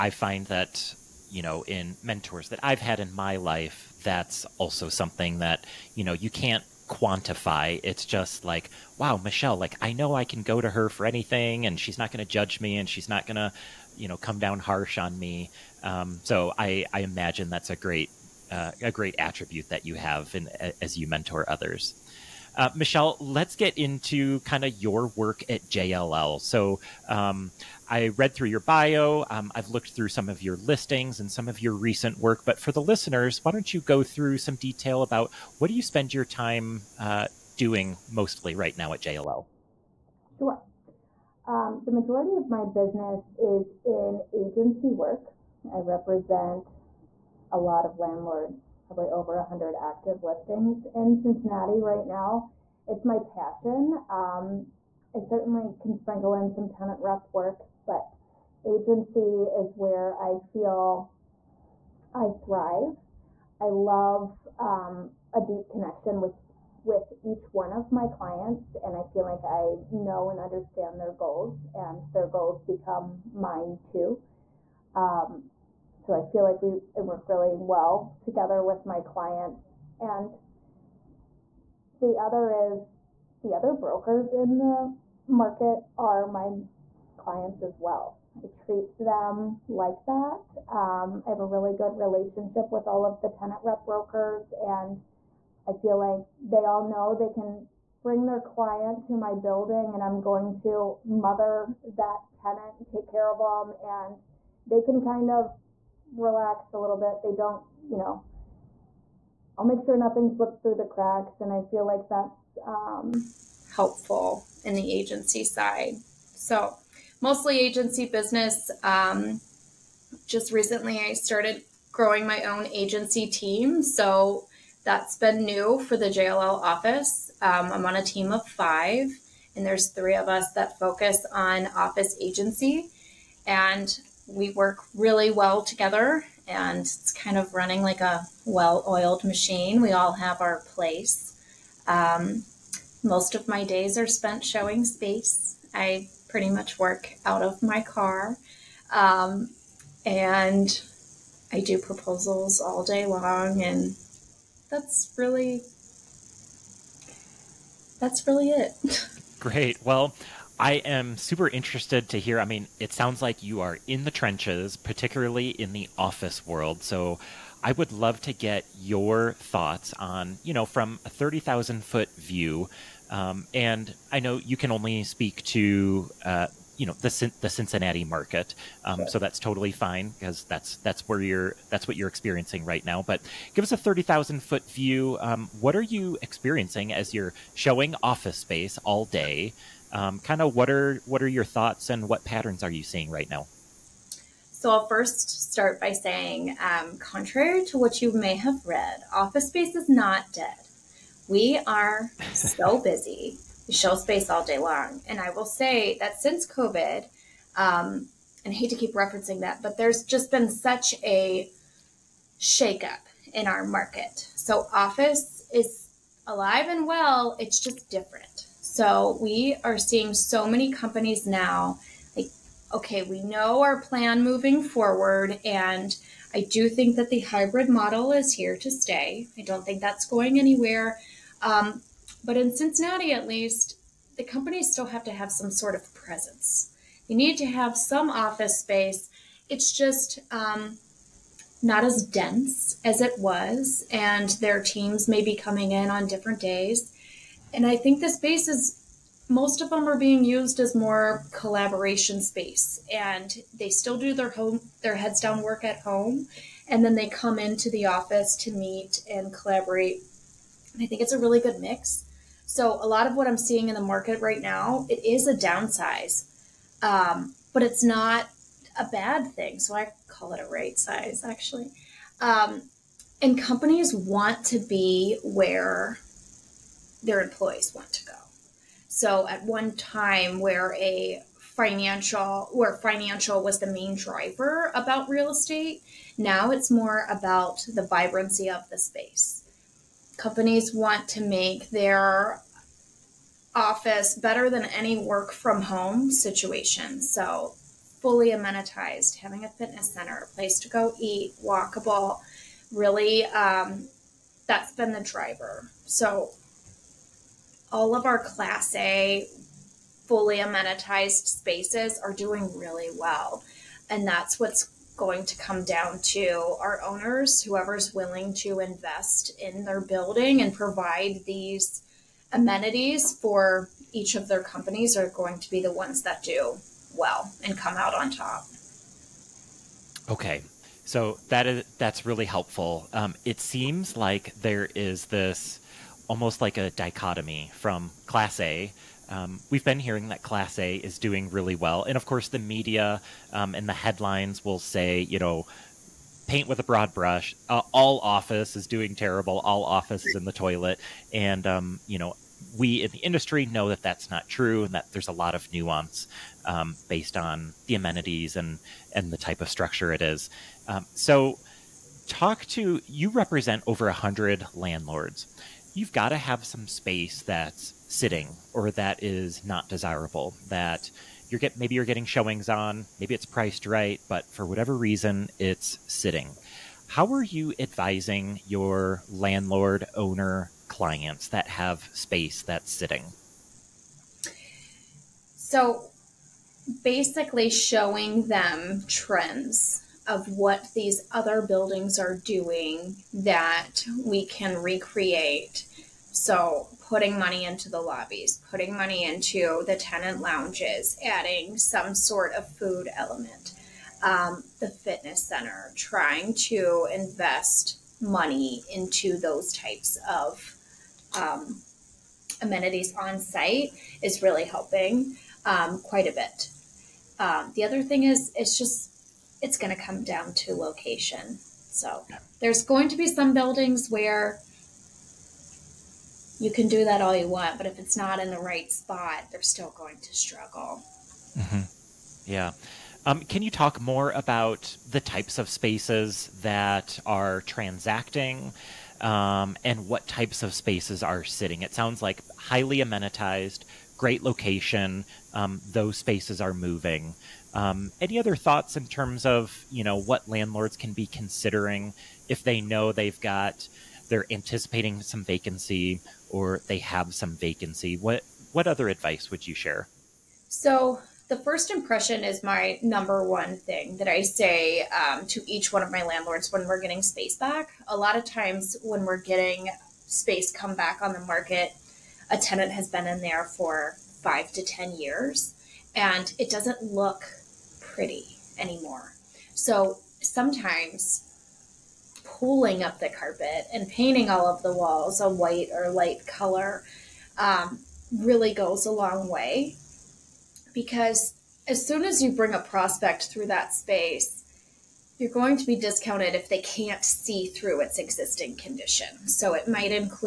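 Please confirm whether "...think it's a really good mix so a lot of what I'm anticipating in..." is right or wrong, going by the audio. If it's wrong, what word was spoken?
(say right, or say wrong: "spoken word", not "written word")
wrong: "seeing", not "anticipating".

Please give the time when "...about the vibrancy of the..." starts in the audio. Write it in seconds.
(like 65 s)
287 s.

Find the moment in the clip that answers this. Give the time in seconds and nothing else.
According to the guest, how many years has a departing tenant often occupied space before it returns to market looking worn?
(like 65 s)
474 s.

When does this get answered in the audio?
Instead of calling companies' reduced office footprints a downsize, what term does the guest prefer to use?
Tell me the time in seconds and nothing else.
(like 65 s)
270 s.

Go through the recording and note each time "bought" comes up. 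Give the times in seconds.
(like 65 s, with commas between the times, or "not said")
not said.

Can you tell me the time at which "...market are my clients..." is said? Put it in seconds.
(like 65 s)
85 s.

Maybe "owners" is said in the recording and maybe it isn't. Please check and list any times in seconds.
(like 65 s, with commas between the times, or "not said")
316 s, 379 s.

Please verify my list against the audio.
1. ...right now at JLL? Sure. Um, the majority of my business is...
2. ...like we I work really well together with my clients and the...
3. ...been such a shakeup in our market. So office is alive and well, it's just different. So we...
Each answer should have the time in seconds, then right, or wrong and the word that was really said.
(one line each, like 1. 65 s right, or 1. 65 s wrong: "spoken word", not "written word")
1. 38 s right
2. 76 s right
3. 210 s right.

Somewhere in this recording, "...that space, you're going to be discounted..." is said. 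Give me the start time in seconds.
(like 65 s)
493 s.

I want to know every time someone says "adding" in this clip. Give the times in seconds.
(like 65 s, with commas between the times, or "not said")
401 s.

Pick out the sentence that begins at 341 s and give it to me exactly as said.
And of course, the media um, and the headlines will say, you know, paint with a broad brush.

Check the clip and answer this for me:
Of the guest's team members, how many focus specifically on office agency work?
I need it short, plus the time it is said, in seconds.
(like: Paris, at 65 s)
3, at 129 s.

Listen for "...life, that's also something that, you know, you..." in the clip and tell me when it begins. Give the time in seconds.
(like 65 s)
3 s.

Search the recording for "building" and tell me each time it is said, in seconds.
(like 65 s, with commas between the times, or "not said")
99 s, 319 s, 391 s, 423 s.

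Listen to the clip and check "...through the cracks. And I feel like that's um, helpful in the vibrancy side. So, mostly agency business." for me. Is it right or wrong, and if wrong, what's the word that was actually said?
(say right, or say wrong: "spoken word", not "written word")
wrong: "agency", not "vibrancy".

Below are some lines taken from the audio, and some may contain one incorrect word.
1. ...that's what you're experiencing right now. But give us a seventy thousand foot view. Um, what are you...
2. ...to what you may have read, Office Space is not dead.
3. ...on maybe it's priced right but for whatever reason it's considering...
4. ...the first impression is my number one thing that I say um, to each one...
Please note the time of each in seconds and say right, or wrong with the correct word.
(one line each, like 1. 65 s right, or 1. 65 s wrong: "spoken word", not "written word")
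1. 181 s wrong: "thirty", not "seventy"
2. 197 s right
3. 372 s wrong: "sitting", not "considering"
4. 461 s right.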